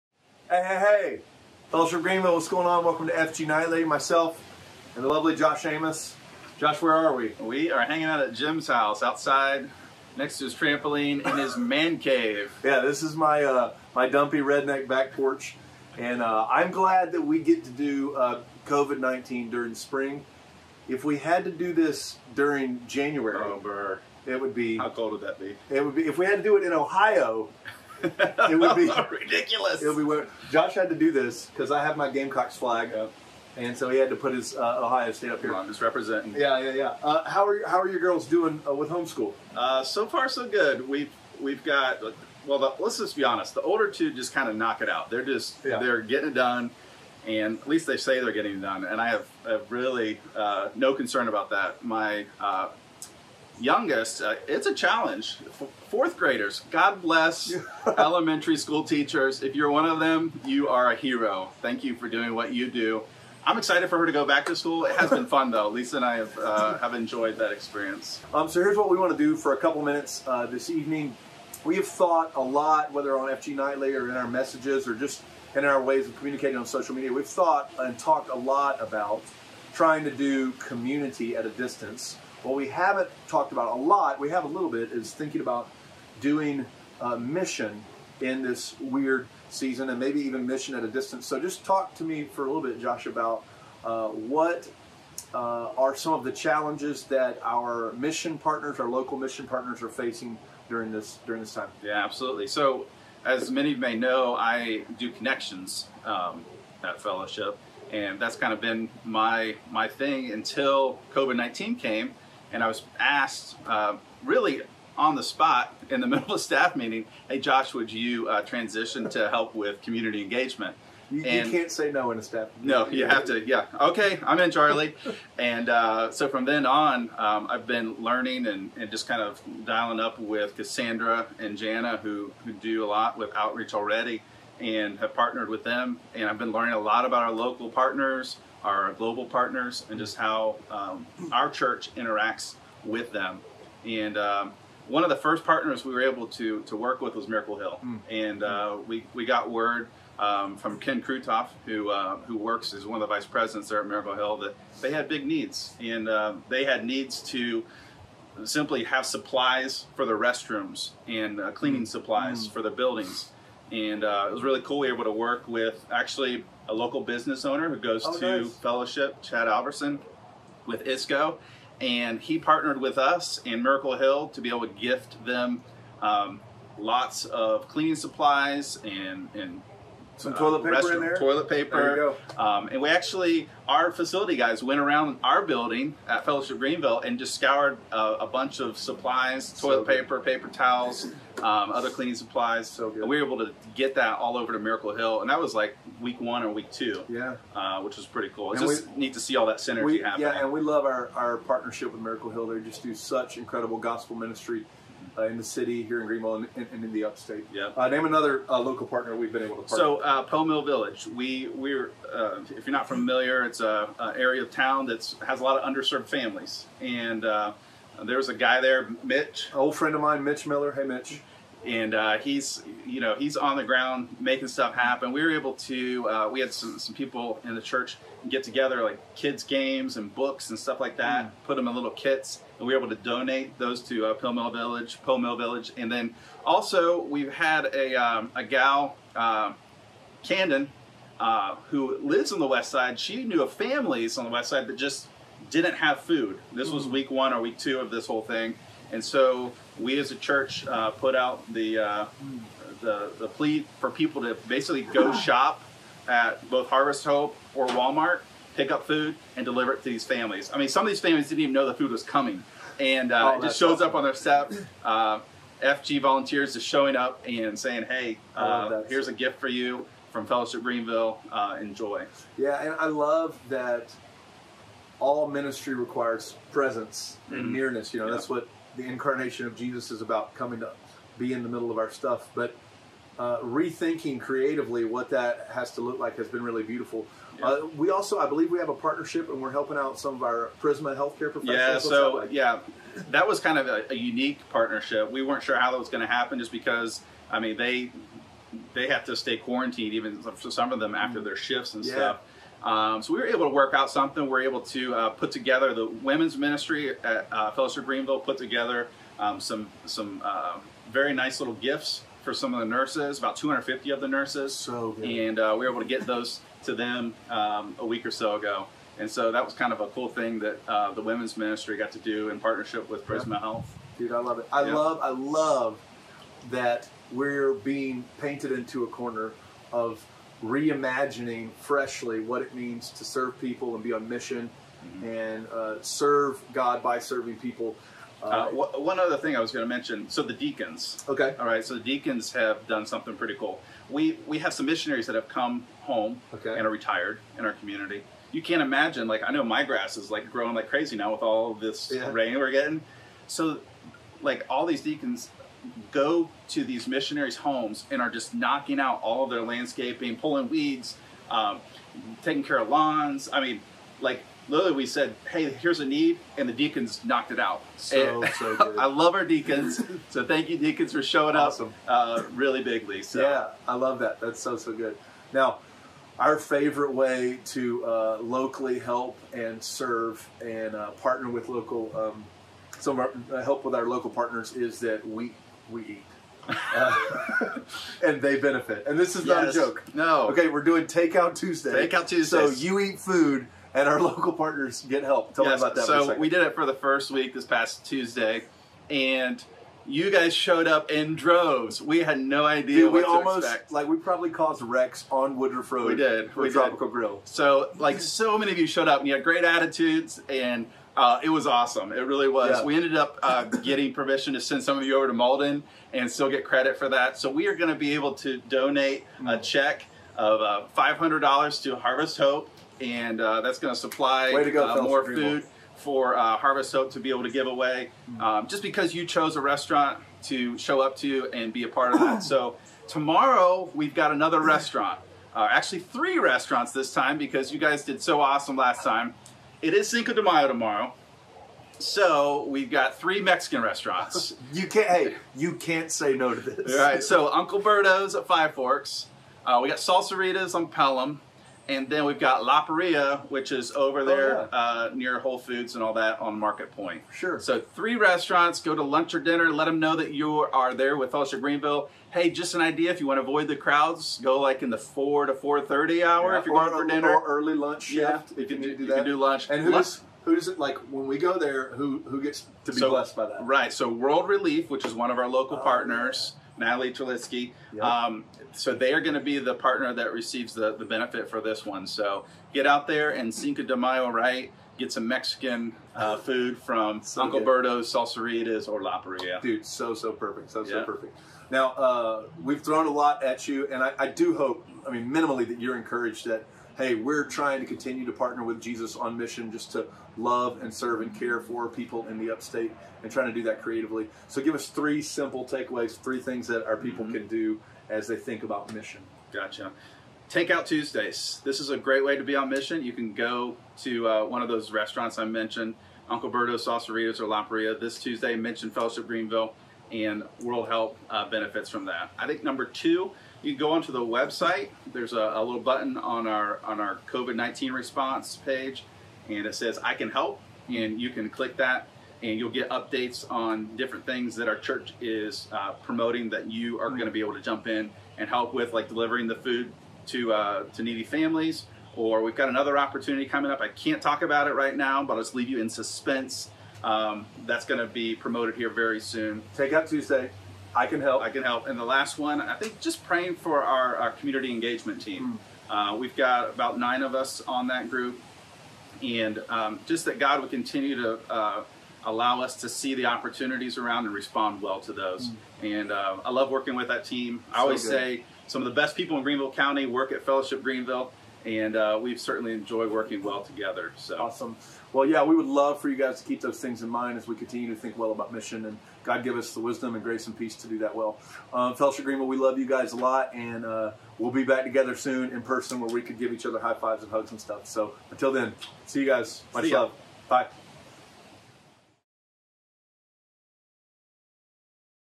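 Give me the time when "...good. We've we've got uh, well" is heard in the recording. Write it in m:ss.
0:40.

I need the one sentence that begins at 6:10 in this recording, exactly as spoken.
so thank you, deacons, for showing awesome.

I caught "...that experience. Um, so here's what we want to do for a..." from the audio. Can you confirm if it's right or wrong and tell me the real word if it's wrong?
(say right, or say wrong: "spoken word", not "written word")
right.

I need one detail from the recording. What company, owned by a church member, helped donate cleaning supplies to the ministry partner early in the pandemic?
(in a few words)
ISCO.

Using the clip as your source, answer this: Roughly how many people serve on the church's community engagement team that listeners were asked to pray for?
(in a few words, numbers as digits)
9.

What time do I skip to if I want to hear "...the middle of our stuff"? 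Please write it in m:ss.
4:41.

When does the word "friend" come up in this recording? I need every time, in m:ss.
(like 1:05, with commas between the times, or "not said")
3:39.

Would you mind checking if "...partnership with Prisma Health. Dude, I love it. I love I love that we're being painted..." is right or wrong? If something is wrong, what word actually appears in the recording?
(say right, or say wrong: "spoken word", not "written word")
right.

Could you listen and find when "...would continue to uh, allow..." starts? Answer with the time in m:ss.
9:20.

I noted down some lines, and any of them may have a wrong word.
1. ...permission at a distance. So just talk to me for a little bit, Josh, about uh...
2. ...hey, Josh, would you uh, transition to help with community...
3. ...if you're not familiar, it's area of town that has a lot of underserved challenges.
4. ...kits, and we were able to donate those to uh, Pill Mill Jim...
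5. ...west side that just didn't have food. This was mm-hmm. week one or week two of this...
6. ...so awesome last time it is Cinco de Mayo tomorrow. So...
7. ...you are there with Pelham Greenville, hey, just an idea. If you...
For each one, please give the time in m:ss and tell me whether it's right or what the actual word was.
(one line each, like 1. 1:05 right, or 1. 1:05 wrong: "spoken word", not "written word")
1. 1:30 wrong: "mission", not "permission"
2. 1:57 right
3. 3:32 wrong: "families", not "challenges"
4. 3:51 wrong: "Village", not "Jim"
5. 4:04 right
6. 7:18 right
7. 7:40 wrong: "Fellowship", not "Pelham".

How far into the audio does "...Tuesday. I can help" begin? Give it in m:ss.
9:09.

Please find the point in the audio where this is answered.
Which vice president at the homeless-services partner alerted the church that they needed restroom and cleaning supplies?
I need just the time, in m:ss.
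2:30.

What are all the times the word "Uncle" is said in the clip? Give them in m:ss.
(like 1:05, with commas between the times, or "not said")
7:27, 8:07, 8:36.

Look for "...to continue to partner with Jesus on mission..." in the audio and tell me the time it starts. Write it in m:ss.
8:17.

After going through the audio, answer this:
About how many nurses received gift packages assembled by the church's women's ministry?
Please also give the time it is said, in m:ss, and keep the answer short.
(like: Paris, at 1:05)
250, at 5:13.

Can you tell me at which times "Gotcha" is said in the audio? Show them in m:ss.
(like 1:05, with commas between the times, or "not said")
8:29.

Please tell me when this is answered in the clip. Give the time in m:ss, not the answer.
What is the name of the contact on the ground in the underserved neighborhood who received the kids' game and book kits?
3:40.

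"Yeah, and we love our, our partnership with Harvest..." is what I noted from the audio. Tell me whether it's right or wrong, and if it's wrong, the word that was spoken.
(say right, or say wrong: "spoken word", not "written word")
wrong: "Miracle", not "Harvest".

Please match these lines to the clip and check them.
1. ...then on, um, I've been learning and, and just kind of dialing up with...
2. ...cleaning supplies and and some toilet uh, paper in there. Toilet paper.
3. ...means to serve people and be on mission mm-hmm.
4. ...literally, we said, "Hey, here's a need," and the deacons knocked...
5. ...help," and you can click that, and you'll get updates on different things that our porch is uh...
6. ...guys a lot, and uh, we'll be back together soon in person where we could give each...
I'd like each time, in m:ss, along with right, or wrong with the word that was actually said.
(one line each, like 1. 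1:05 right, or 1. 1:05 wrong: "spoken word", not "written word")
1. 2:06 right
2. 2:57 right
3. 5:32 right
4. 6:04 right
5. 8:50 wrong: "church", not "porch"
6. 9:42 right.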